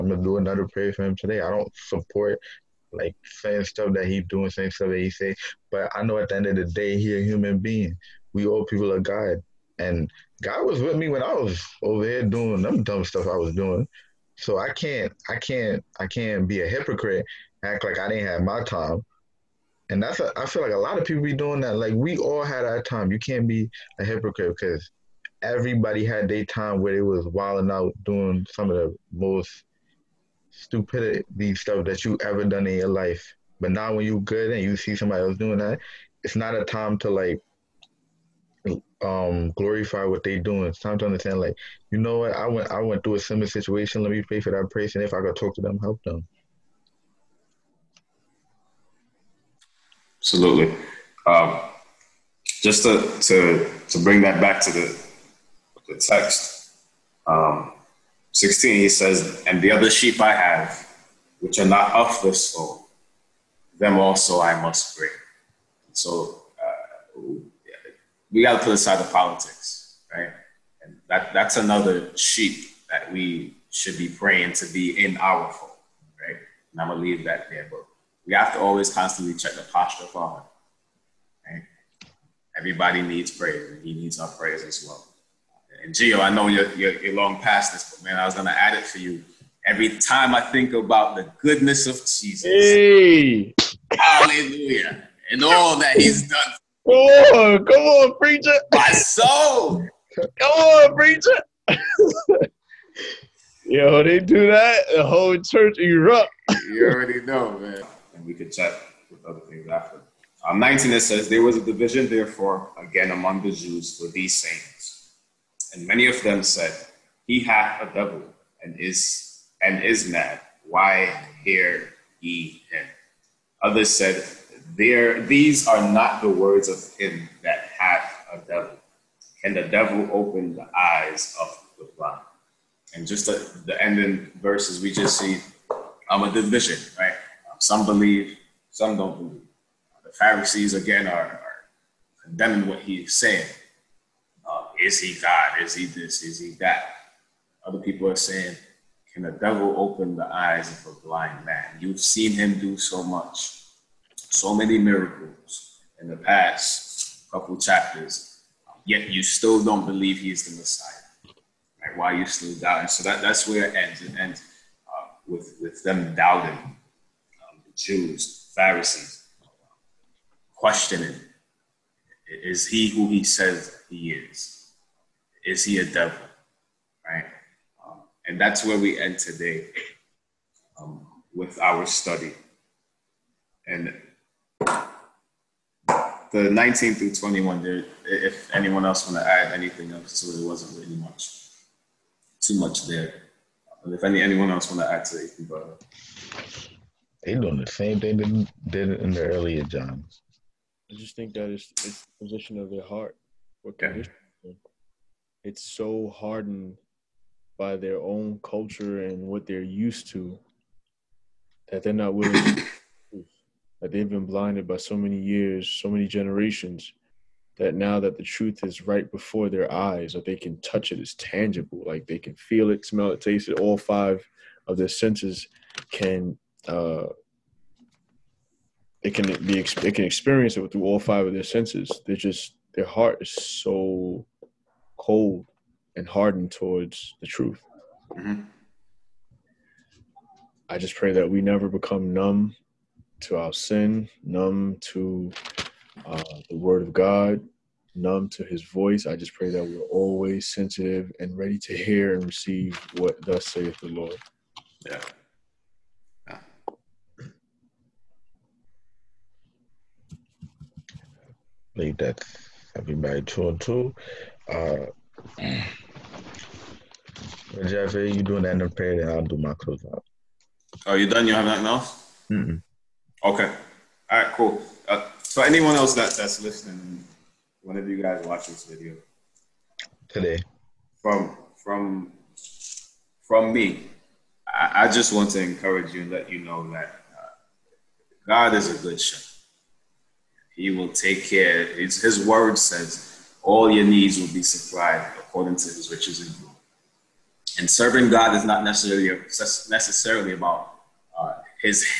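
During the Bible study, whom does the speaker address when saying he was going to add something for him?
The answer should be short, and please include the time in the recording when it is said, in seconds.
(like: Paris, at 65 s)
Gio, at 85 s.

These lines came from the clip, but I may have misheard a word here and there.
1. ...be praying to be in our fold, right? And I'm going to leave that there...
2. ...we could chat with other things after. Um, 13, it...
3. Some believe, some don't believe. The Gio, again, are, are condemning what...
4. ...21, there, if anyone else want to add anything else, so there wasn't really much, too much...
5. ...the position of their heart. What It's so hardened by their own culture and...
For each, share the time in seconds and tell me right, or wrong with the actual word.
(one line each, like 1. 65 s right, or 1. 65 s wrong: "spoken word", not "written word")
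1. 73 s right
2. 108 s wrong: "19", not "13"
3. 137 s wrong: "Pharisees", not "Gio"
4. 187 s right
5. 202 s right.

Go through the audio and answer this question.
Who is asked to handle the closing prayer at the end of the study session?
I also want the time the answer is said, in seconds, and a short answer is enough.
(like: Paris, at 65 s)
Jeff, at 267 s.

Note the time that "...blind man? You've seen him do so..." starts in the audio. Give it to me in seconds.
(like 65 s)
151 s.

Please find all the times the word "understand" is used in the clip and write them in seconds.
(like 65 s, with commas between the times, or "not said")
41 s.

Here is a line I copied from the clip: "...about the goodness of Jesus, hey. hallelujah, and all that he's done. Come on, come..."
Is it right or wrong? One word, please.
right.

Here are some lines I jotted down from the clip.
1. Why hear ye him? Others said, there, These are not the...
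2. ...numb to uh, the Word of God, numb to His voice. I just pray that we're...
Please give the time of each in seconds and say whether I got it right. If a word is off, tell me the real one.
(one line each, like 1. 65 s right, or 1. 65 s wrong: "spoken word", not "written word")
1. 120 s right
2. 244 s right.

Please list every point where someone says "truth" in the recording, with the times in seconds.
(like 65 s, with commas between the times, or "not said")
218 s, 237 s.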